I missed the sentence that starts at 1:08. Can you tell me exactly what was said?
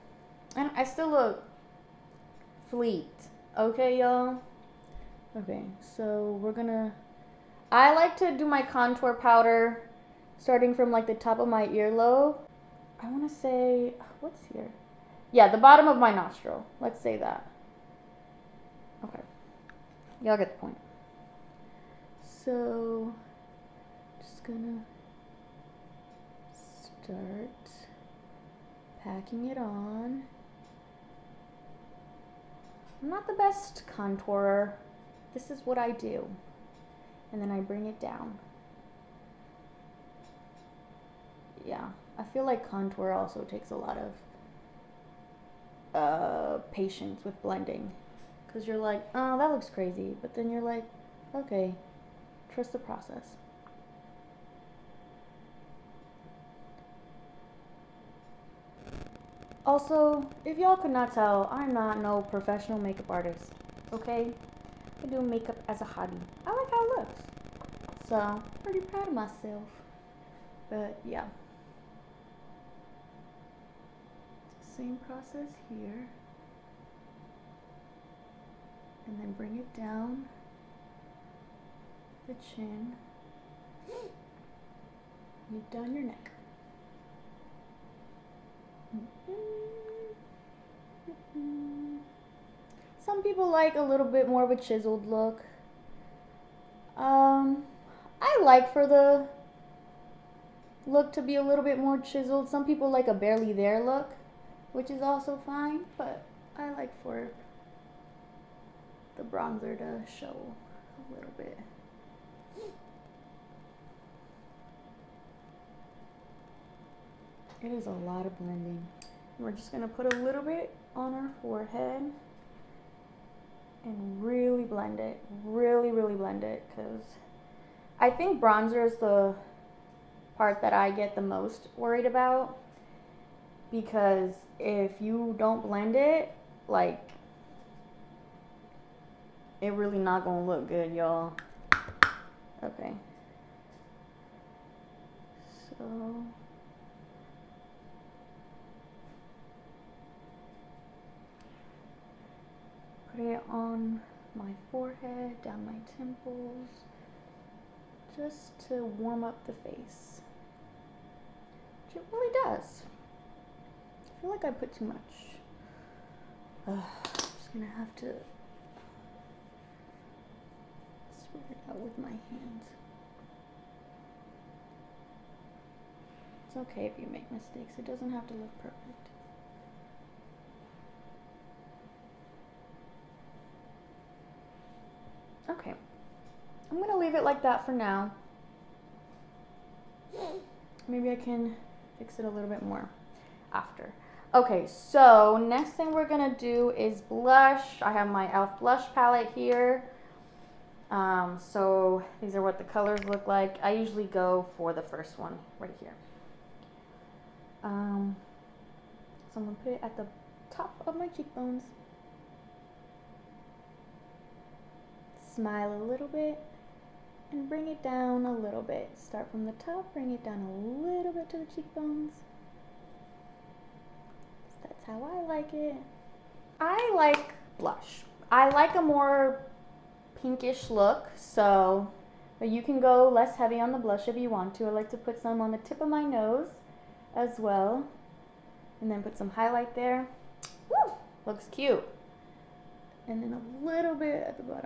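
So, I'm pretty proud of myself.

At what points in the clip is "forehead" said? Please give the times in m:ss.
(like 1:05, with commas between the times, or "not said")
2:01, 2:34.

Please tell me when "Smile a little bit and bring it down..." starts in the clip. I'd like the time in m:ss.
3:35.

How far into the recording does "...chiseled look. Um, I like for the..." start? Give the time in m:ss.
1:34.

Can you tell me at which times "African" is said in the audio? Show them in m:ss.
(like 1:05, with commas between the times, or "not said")
not said.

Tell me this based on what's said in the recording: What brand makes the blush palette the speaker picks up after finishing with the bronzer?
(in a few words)
e.l.f.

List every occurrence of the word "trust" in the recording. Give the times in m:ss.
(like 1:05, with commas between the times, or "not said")
0:52.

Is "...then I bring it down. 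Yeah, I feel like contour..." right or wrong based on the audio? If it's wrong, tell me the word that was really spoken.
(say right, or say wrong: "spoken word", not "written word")
right.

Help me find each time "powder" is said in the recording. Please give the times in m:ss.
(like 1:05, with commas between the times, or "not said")
0:09.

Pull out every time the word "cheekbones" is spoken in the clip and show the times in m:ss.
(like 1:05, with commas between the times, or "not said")
3:31, 3:41.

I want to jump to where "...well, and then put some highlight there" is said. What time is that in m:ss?
3:57.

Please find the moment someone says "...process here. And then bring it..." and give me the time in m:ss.
1:15.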